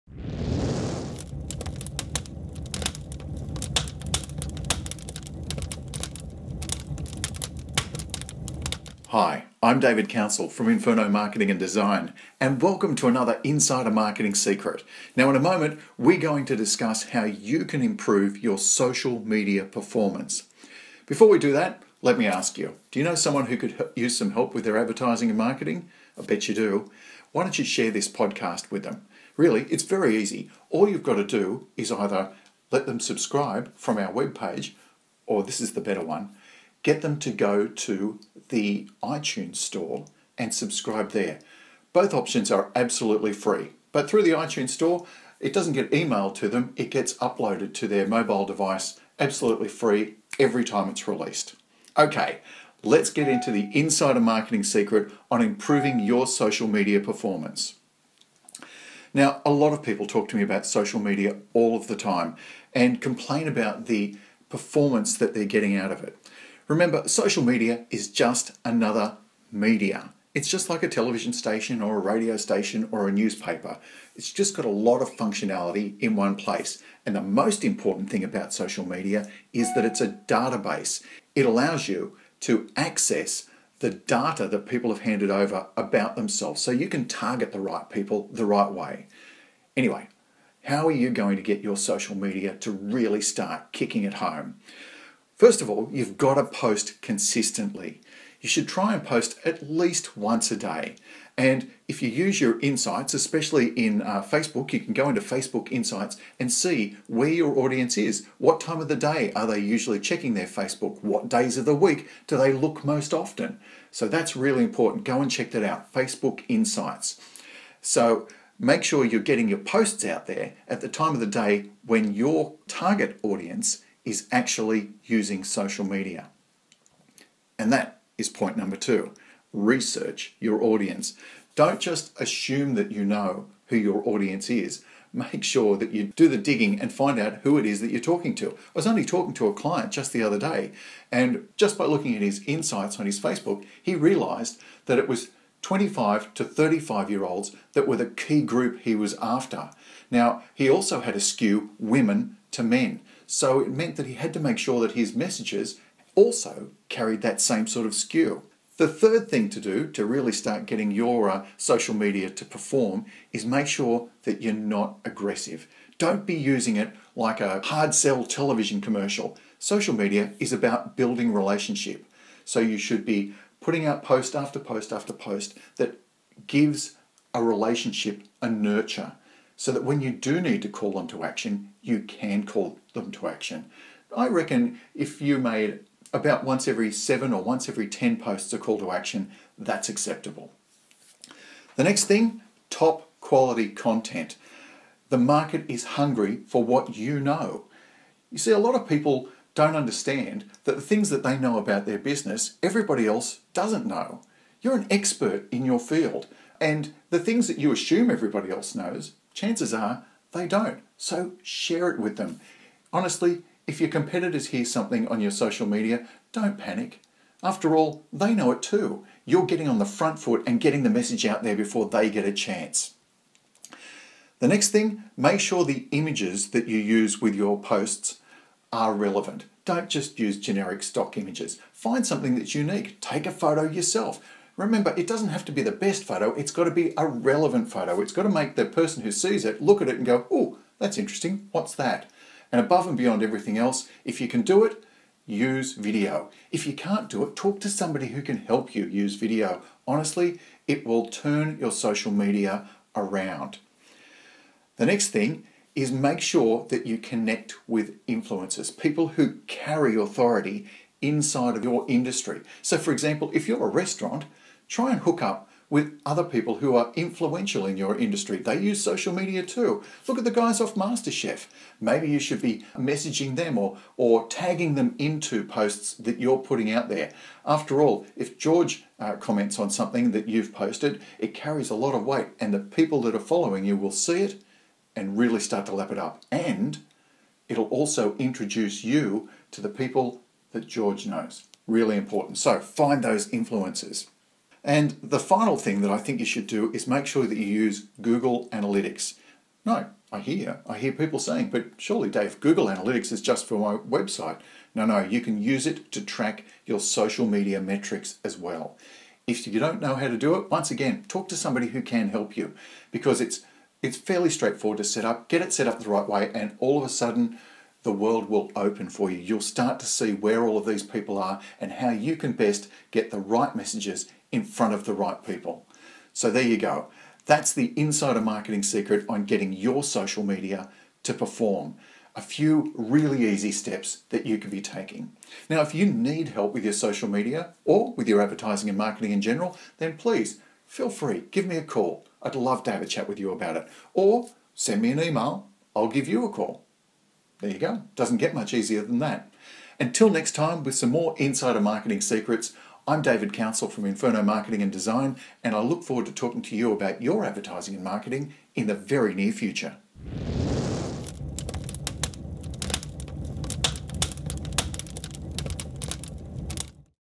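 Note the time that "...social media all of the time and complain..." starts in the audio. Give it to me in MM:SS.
01:00.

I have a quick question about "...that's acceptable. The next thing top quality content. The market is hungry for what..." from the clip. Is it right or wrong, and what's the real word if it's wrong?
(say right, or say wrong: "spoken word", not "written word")
right.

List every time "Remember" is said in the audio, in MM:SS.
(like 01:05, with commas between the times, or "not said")
01:06, 03:54.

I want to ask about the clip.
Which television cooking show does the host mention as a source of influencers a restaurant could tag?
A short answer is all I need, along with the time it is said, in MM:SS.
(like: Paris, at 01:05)
MasterChef, at 04:30.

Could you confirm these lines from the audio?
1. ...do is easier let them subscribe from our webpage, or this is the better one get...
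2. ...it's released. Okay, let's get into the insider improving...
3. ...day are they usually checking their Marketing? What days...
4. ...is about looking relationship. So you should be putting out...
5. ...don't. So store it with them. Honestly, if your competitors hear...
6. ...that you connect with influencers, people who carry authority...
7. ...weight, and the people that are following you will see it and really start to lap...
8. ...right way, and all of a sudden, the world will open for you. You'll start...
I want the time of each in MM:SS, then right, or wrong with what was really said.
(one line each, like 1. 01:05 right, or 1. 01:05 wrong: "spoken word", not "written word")
1. 00:31 wrong: "either", not "easier"
2. 00:50 wrong: "marketing", not "improving"
3. 01:48 wrong: "Facebook", not "Marketing"
4. 02:50 wrong: "building", not "looking"
5. 03:30 wrong: "share", not "store"
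6. 04:16 right
7. 04:42 right
8. 05:15 right.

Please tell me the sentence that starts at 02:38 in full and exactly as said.
The third thing to do to really start getting your uh, social media to perform is make sure that you're not aggressive.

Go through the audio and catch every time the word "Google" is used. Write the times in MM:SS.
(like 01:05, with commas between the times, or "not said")
04:58, 05:02.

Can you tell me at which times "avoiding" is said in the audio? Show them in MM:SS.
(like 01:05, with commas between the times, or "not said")
not said.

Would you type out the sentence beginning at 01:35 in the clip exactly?
First of all, you've got to post consistently.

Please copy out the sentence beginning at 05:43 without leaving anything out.
Or send me an email, I'll give you a call.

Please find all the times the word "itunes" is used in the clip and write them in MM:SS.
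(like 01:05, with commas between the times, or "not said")
00:39, 00:44.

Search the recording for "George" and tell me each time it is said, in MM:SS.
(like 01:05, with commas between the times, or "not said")
04:38, 04:50.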